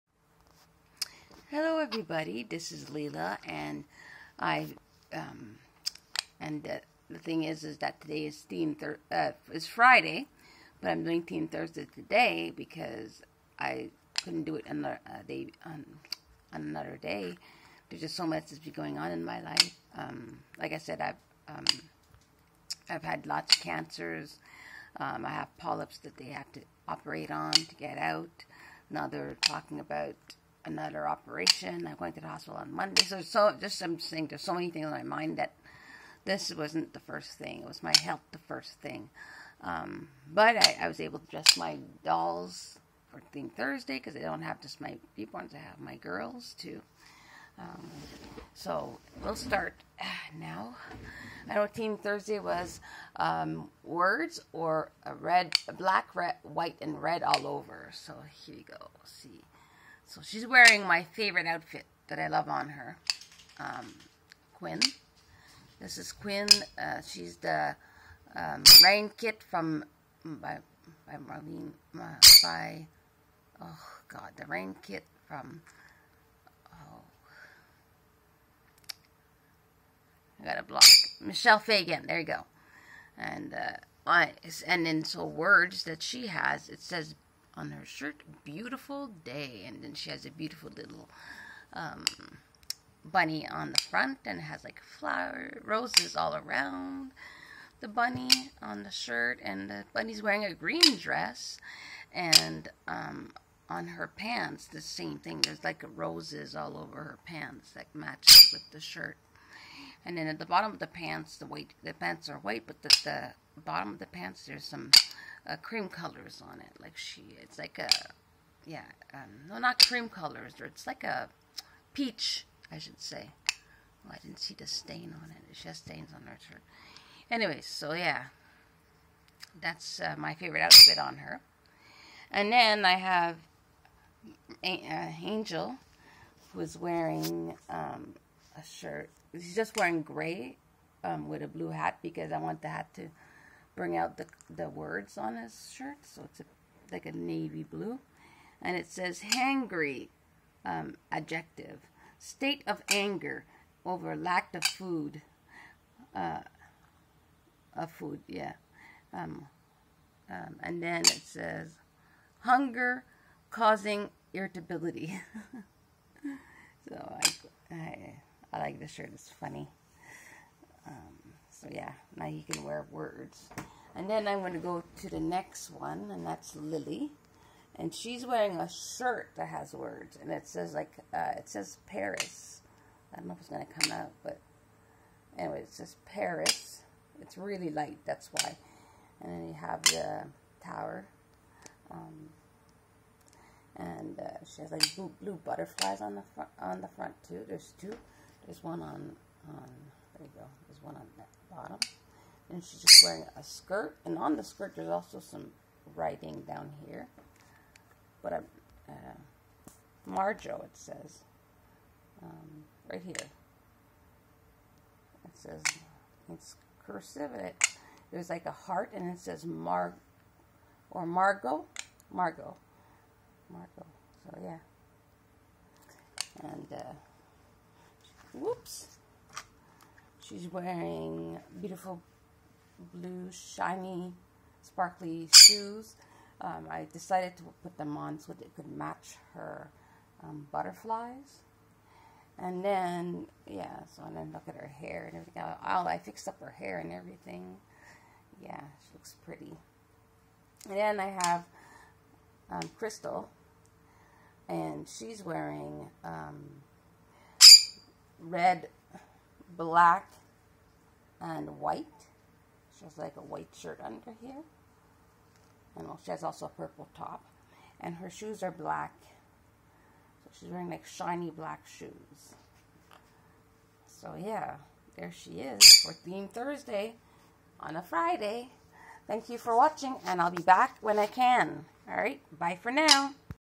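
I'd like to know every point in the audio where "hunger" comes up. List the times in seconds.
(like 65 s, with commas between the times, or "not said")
162 s.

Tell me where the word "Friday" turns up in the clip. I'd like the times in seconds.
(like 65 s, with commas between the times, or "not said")
9 s, 277 s.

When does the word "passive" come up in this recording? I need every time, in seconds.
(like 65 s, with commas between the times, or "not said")
not said.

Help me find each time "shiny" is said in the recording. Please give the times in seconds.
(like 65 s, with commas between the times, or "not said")
233 s, 270 s.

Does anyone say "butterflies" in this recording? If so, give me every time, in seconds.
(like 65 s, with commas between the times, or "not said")
195 s, 240 s.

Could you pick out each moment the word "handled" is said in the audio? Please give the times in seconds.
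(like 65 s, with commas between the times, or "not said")
not said.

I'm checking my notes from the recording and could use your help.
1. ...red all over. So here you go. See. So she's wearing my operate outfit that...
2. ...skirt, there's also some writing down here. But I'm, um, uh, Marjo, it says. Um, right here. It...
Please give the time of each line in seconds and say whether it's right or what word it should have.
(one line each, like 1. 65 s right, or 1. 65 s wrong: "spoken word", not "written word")
1. 57 s wrong: "favorite", not "operate"
2. 204 s right.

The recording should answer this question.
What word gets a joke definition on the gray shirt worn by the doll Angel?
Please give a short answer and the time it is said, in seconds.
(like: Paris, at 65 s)
Hangry, at 149 s.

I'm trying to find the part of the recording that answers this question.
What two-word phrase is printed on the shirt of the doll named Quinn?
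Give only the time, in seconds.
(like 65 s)
88 s.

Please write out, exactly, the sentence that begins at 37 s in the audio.
It was my health the first thing.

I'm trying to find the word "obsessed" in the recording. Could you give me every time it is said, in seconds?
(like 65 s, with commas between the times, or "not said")
not said.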